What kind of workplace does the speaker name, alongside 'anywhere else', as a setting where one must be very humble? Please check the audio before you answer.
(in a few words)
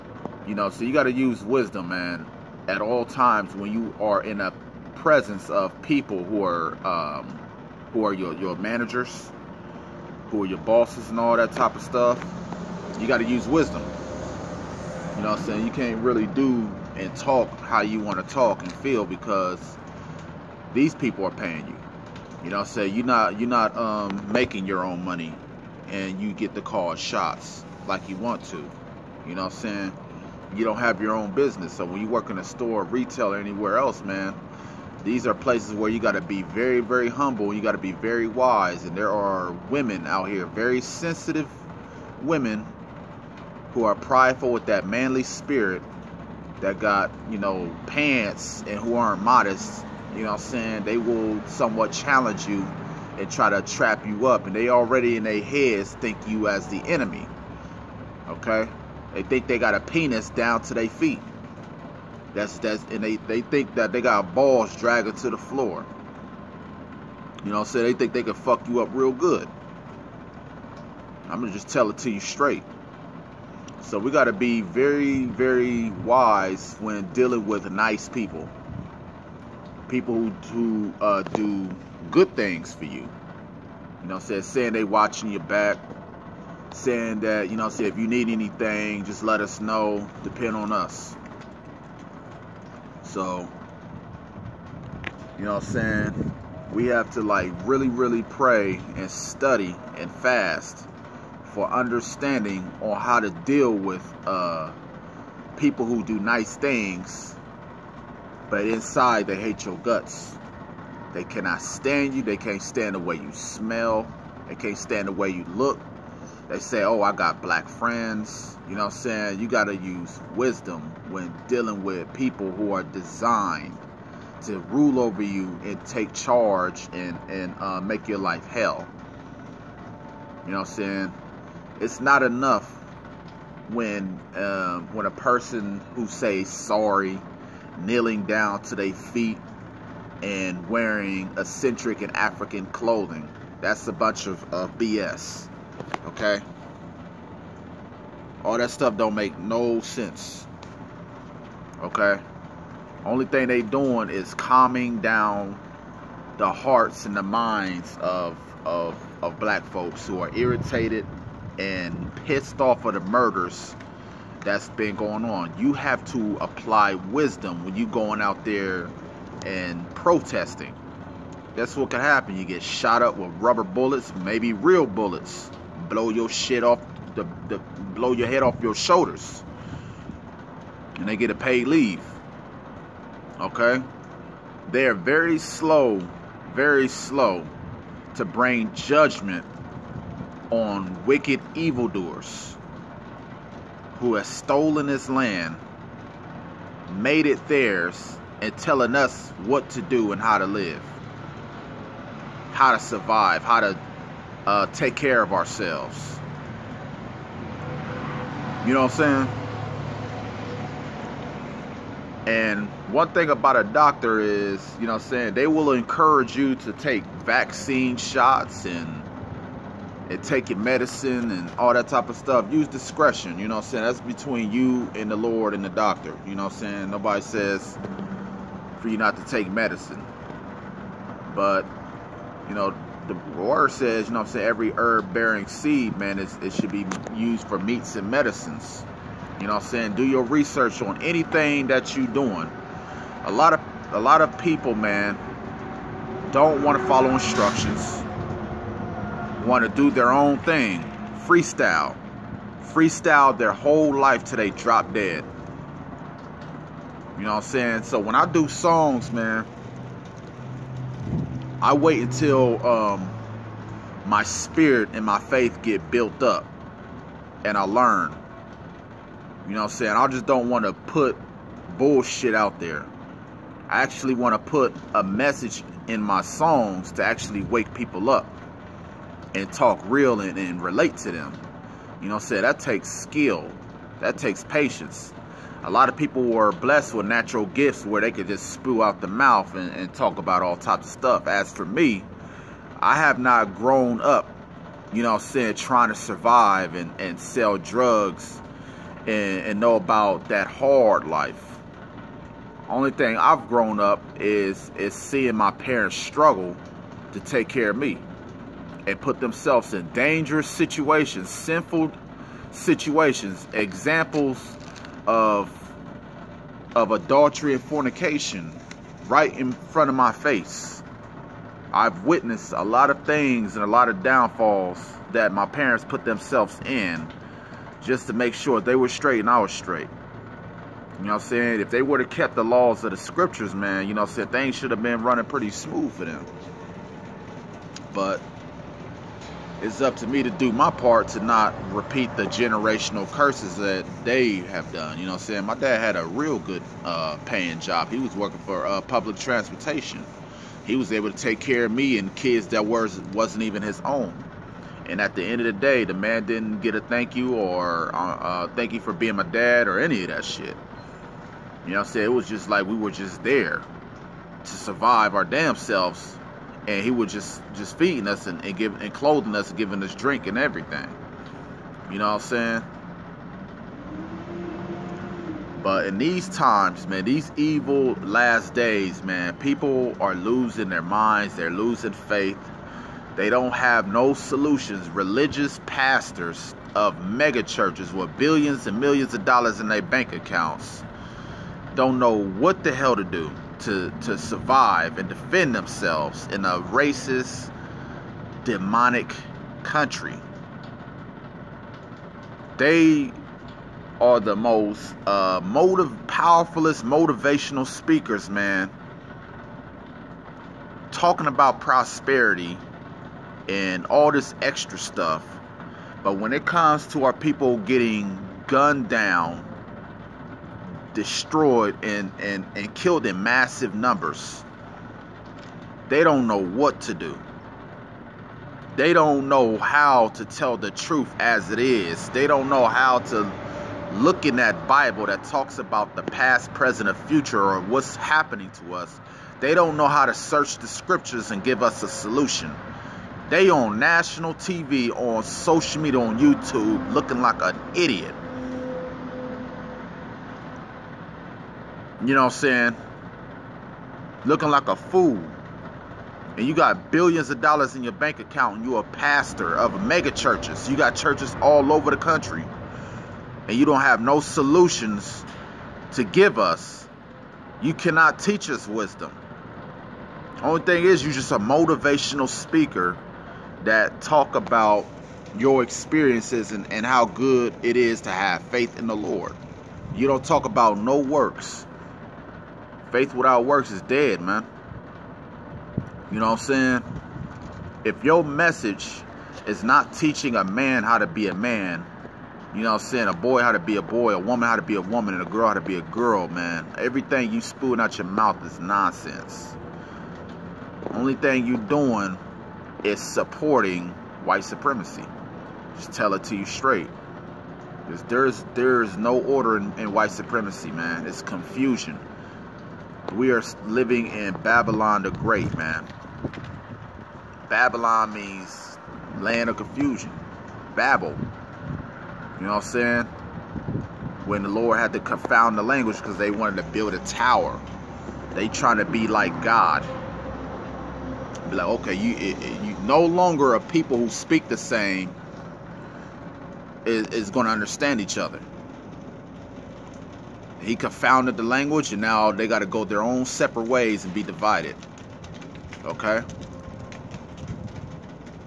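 retail.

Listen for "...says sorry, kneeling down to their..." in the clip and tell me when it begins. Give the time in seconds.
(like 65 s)
136 s.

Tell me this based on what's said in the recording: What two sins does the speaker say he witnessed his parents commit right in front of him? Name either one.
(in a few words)
adultery.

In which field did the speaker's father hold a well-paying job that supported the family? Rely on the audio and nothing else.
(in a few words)
public transportation.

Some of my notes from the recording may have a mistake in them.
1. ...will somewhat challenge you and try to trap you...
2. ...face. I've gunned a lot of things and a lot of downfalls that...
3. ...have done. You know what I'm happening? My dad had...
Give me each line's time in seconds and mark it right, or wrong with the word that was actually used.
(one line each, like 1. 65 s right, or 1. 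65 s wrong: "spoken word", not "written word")
1. 50 s right
2. 320 s wrong: "witnessed", not "gunned"
3. 344 s wrong: "saying", not "happening".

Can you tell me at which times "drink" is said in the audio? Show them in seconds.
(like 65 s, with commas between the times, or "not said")
369 s.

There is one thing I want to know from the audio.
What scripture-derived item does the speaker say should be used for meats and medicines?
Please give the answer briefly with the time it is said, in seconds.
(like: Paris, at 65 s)
every herb bearing seed, at 234 s.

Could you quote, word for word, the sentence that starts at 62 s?
That's that's and they, they think that they got balls dragging to the floor.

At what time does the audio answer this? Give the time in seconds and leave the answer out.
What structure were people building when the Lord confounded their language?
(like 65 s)
526 s.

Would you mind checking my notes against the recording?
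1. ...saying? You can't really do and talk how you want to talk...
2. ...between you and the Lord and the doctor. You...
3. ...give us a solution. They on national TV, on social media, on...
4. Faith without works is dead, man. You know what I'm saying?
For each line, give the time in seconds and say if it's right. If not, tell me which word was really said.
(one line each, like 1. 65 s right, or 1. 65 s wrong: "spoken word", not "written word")
1. 15 s right
2. 224 s right
3. 441 s right
4. 482 s right.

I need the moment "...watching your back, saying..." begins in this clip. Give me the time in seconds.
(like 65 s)
84 s.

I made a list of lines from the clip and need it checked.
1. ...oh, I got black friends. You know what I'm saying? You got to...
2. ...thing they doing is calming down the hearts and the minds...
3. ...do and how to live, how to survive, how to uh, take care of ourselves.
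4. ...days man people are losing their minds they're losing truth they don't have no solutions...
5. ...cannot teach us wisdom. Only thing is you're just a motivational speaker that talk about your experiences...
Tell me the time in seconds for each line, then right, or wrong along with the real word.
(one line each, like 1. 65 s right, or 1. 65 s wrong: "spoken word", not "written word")
1. 116 s right
2. 153 s right
3. 199 s right
4. 378 s wrong: "faith", not "truth"
5. 467 s right.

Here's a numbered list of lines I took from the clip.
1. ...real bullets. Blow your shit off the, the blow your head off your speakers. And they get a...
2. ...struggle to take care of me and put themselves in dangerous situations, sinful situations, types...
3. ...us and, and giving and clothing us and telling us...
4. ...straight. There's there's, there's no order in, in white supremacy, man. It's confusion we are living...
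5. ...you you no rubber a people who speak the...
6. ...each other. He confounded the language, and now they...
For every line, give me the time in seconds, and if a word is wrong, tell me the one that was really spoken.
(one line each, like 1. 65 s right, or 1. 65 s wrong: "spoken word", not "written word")
1. 174 s wrong: "shoulders", not "speakers"
2. 305 s wrong: "examples", not "types"
3. 368 s wrong: "giving", not "telling"
4. 506 s right
5. 531 s wrong: "longer", not "rubber"
6. 537 s right.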